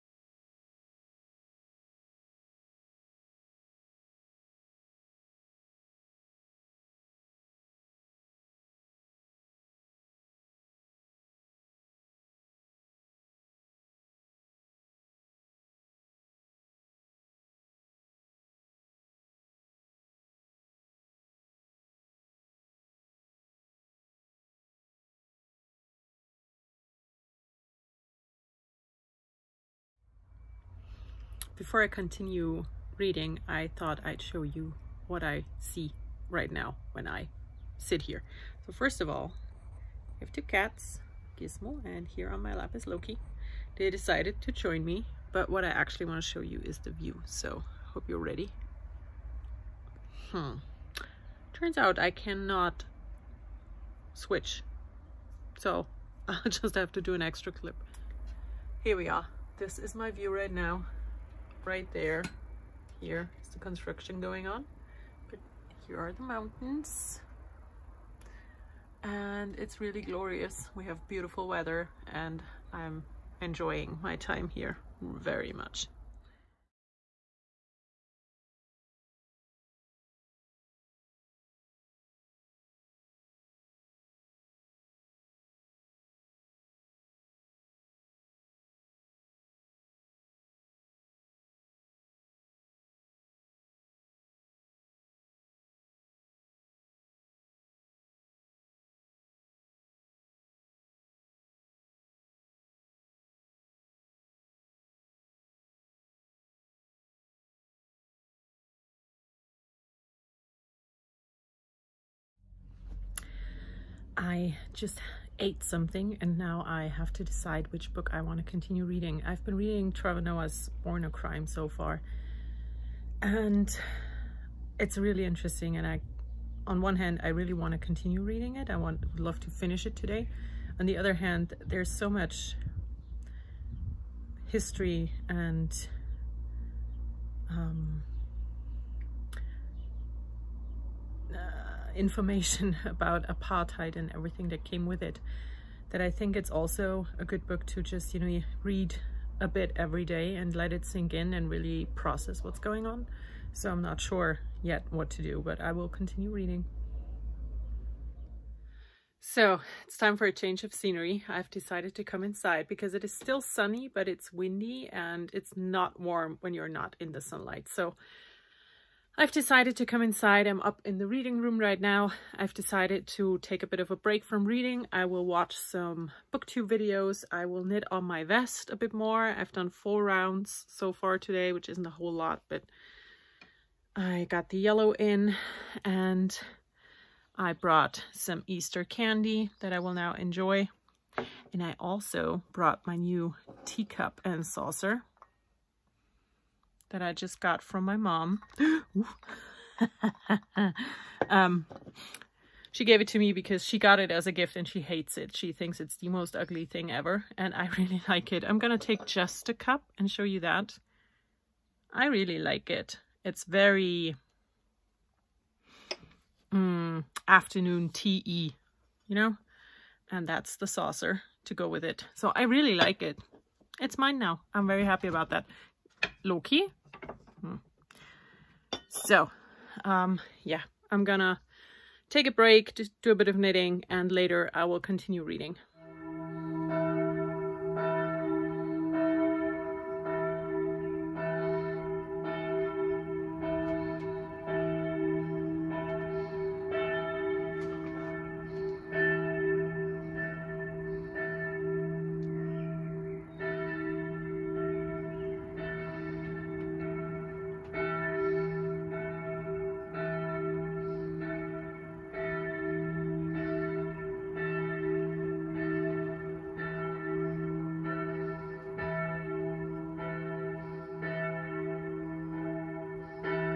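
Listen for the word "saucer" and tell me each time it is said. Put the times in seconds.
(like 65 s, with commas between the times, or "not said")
194 s, 220 s.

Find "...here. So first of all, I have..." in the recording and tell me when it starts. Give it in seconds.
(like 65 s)
38 s.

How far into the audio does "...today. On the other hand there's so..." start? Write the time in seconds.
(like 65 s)
129 s.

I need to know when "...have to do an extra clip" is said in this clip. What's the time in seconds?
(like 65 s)
56 s.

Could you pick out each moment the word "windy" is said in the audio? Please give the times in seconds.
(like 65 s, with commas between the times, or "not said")
164 s.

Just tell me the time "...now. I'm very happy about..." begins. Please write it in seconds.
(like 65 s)
224 s.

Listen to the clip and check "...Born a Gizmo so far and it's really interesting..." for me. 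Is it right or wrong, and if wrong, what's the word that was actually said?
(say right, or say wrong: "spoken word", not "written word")
wrong: "Crime", not "Gizmo".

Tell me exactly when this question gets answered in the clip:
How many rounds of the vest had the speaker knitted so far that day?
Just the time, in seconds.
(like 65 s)
179 s.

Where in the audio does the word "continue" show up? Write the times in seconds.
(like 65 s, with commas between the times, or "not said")
31 s, 118 s, 127 s, 155 s, 234 s.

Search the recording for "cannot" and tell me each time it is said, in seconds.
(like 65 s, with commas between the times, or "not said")
52 s.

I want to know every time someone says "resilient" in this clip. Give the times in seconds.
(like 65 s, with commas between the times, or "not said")
not said.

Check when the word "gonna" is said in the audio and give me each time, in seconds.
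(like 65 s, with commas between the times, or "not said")
208 s, 231 s.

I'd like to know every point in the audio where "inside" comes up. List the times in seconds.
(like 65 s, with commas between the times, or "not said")
162 s, 170 s.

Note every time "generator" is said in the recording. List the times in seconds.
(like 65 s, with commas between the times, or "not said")
not said.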